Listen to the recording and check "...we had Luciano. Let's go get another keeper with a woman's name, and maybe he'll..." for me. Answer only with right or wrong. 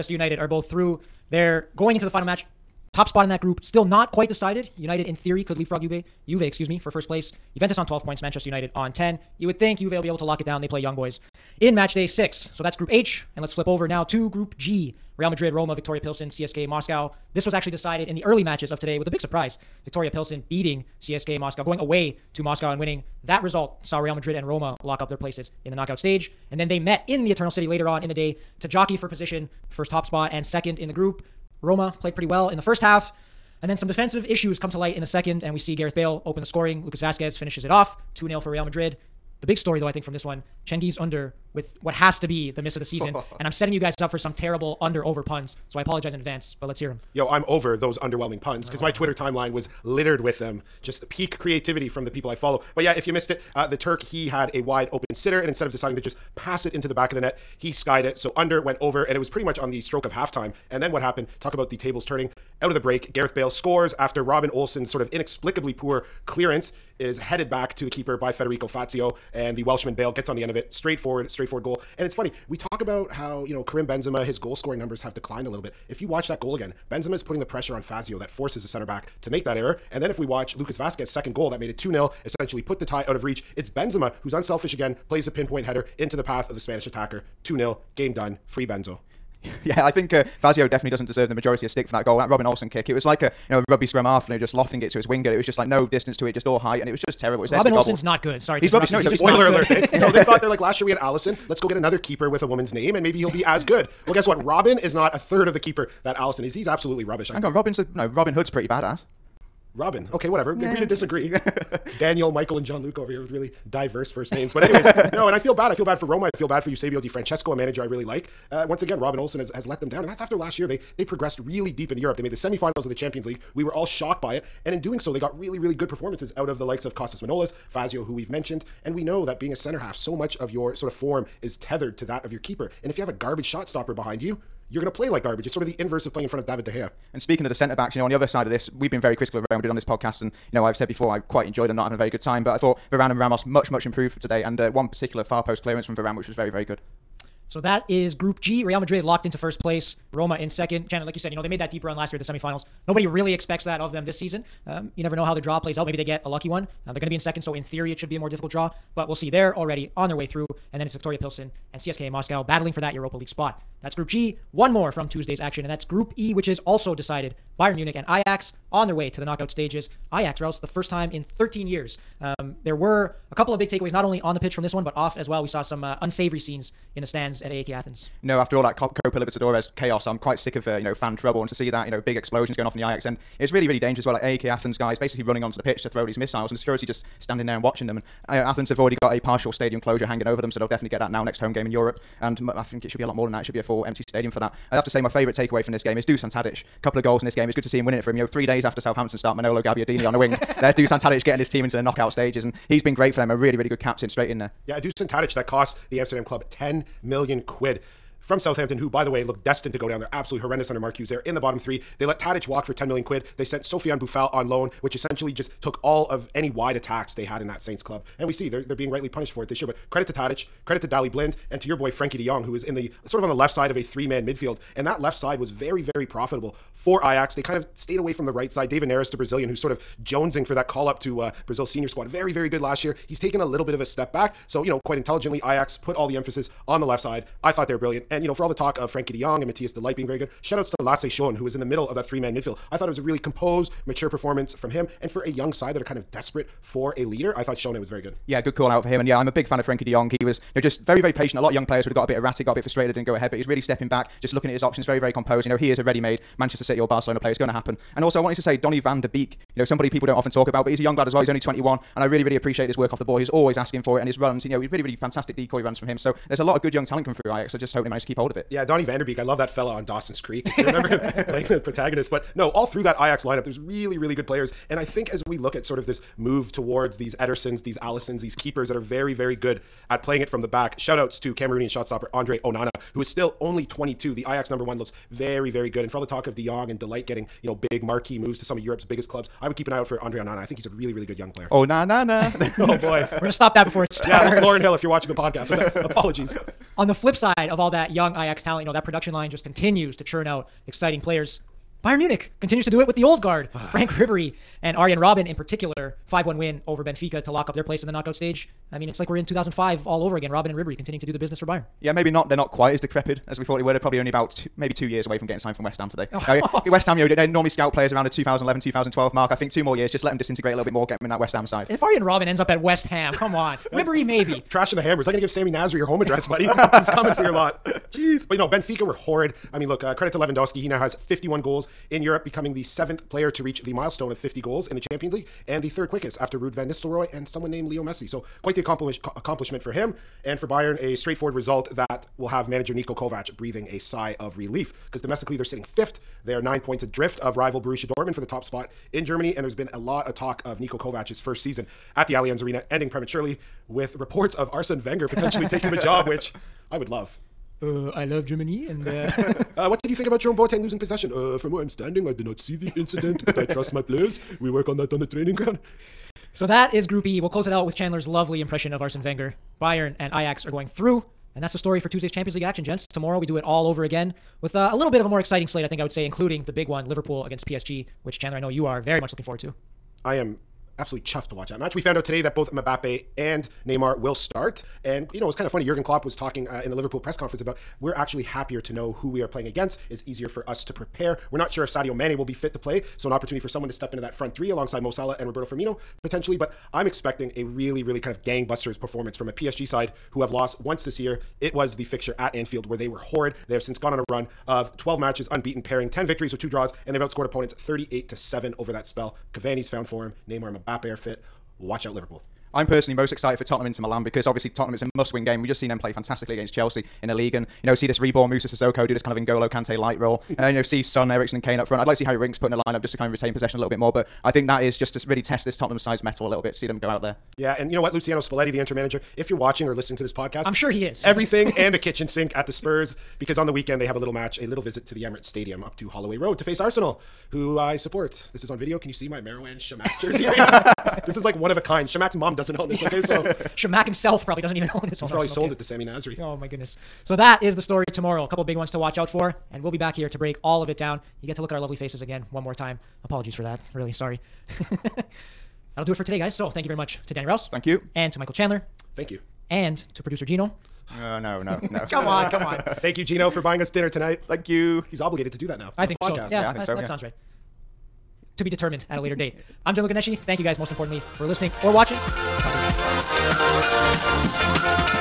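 wrong.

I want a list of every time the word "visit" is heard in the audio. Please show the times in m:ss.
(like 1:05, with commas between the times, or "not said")
7:14.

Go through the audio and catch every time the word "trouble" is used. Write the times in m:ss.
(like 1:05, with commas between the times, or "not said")
3:01.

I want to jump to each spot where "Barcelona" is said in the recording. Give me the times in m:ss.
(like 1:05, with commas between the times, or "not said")
4:16.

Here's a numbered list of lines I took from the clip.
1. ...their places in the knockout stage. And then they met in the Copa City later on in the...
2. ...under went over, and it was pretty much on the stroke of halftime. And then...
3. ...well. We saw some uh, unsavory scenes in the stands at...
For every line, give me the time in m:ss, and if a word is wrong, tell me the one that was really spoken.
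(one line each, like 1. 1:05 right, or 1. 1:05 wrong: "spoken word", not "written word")
1. 0:25 wrong: "Eternal", not "Copa"
2. 0:58 right
3. 2:55 right.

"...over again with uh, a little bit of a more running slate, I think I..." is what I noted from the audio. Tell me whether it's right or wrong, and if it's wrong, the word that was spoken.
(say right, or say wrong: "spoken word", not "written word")
wrong: "exciting", not "running".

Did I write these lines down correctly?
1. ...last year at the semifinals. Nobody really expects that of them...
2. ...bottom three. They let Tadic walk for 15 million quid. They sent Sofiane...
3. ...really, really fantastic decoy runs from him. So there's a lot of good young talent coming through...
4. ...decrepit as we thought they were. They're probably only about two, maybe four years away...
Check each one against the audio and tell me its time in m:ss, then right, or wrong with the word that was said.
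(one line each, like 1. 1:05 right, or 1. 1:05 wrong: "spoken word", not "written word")
1. 2:31 right
2. 3:31 wrong: "10", not "15"
3. 4:24 right
4. 5:12 wrong: "two", not "four".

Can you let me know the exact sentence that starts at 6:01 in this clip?
Uh, from where I'm standing, I did not see the incident, but I trust my players.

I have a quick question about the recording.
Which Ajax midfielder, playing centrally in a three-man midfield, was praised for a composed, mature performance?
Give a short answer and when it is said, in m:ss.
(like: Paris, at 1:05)
Lasse Schöne, at 4:00.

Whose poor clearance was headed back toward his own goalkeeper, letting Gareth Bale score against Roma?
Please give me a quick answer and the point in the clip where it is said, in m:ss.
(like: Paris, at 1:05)
Federico Fazio, at 1:08.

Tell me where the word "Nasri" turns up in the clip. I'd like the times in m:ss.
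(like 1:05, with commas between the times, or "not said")
5:25, 7:25.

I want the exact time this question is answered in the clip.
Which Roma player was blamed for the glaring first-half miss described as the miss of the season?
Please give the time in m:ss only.
0:40.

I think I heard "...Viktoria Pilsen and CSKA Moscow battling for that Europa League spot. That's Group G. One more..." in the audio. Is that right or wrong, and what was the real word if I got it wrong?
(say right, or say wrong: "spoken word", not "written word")
right.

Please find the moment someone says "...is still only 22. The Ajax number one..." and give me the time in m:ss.
4:43.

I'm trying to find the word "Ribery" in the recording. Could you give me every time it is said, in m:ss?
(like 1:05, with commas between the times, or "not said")
5:03, 5:10, 5:23.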